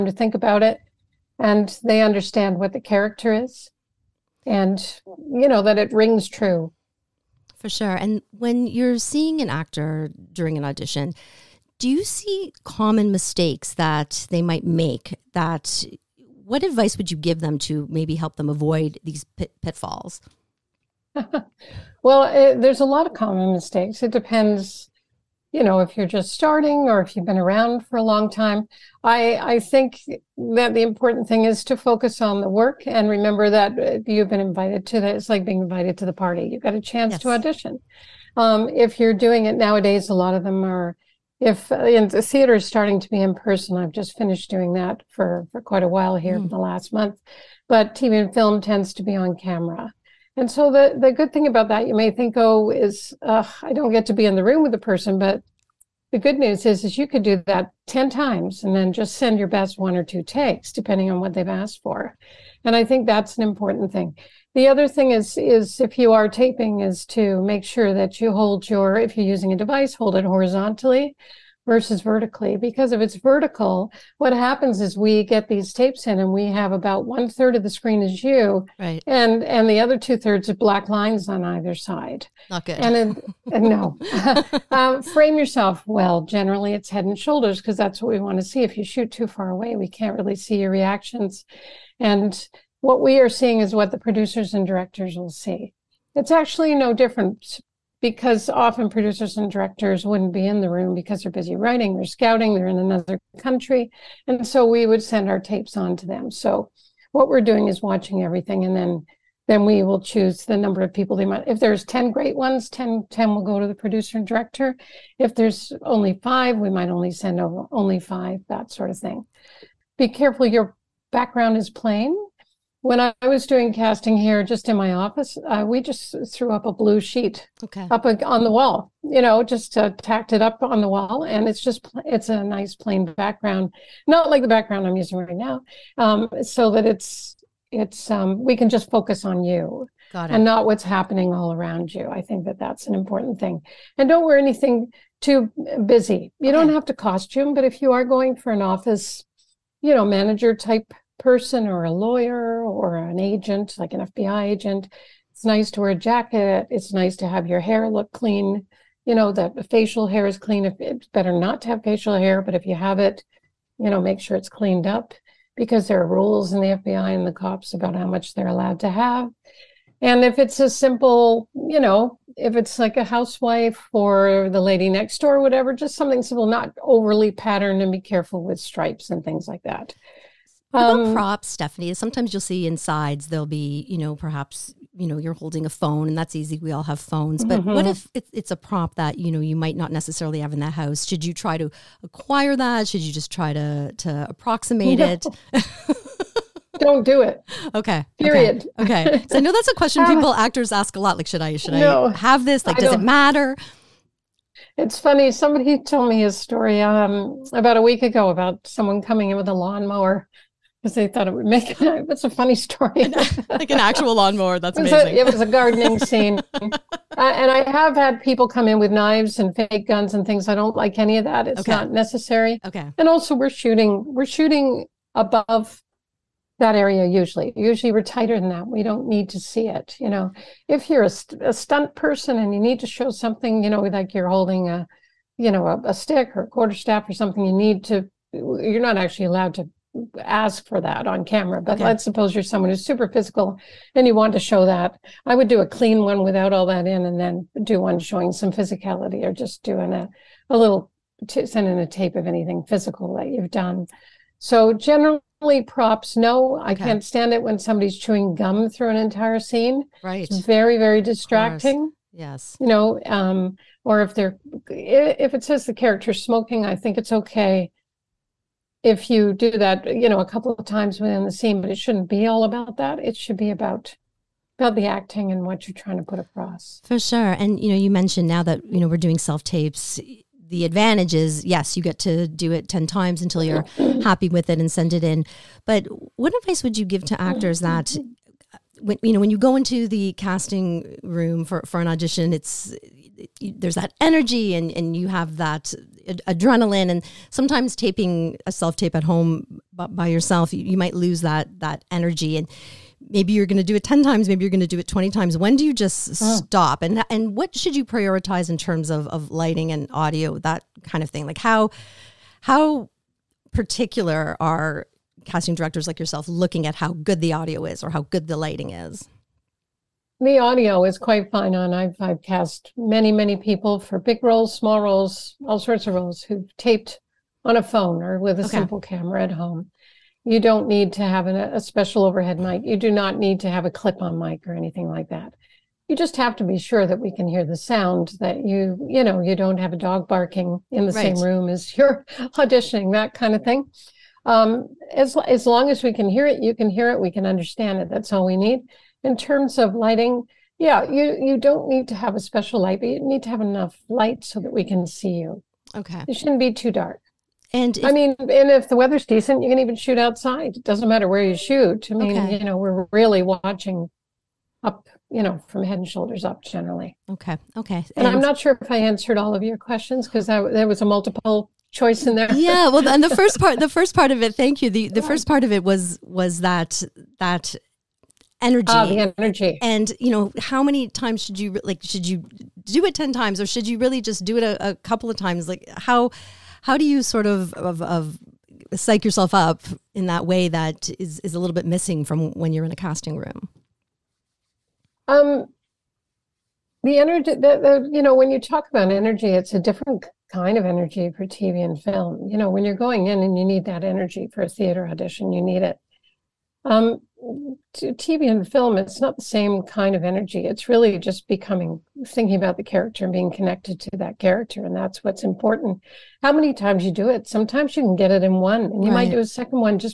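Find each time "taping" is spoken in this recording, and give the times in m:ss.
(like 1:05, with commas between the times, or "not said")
1:06, 4:57.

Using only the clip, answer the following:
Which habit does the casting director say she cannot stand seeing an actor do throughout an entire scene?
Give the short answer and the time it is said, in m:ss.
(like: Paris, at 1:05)
Chewing gum, at 4:17.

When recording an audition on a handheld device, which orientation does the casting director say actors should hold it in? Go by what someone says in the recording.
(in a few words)
Horizontally.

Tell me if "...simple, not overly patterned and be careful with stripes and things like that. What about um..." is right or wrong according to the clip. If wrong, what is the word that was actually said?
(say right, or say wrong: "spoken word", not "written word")
right.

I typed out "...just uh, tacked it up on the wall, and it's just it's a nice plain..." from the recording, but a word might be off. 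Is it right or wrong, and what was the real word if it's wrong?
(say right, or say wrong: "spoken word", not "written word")
right.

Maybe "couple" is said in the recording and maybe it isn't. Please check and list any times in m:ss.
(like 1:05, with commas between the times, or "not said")
4:30, 6:24.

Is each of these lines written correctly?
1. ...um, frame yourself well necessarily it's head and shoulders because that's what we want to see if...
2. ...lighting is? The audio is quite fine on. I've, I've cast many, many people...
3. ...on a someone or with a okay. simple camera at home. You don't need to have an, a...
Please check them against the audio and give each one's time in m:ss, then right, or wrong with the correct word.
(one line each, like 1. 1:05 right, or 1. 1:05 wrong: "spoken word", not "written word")
1. 1:24 wrong: "generally", not "necessarily"
2. 5:18 right
3. 5:27 wrong: "phone", not "someone".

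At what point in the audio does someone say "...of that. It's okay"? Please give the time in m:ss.
3:41.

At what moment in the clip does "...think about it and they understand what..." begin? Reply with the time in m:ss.
0:00.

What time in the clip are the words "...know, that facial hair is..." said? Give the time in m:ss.
2:39.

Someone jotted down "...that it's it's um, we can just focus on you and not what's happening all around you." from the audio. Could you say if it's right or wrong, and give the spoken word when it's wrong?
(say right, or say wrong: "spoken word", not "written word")
right.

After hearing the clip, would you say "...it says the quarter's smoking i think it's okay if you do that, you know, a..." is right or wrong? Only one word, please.
wrong.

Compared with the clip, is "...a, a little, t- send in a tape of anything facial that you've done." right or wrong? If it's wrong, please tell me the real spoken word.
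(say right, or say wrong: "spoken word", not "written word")
wrong: "physical", not "facial".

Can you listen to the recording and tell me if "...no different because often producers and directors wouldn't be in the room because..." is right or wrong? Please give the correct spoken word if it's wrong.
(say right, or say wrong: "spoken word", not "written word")
right.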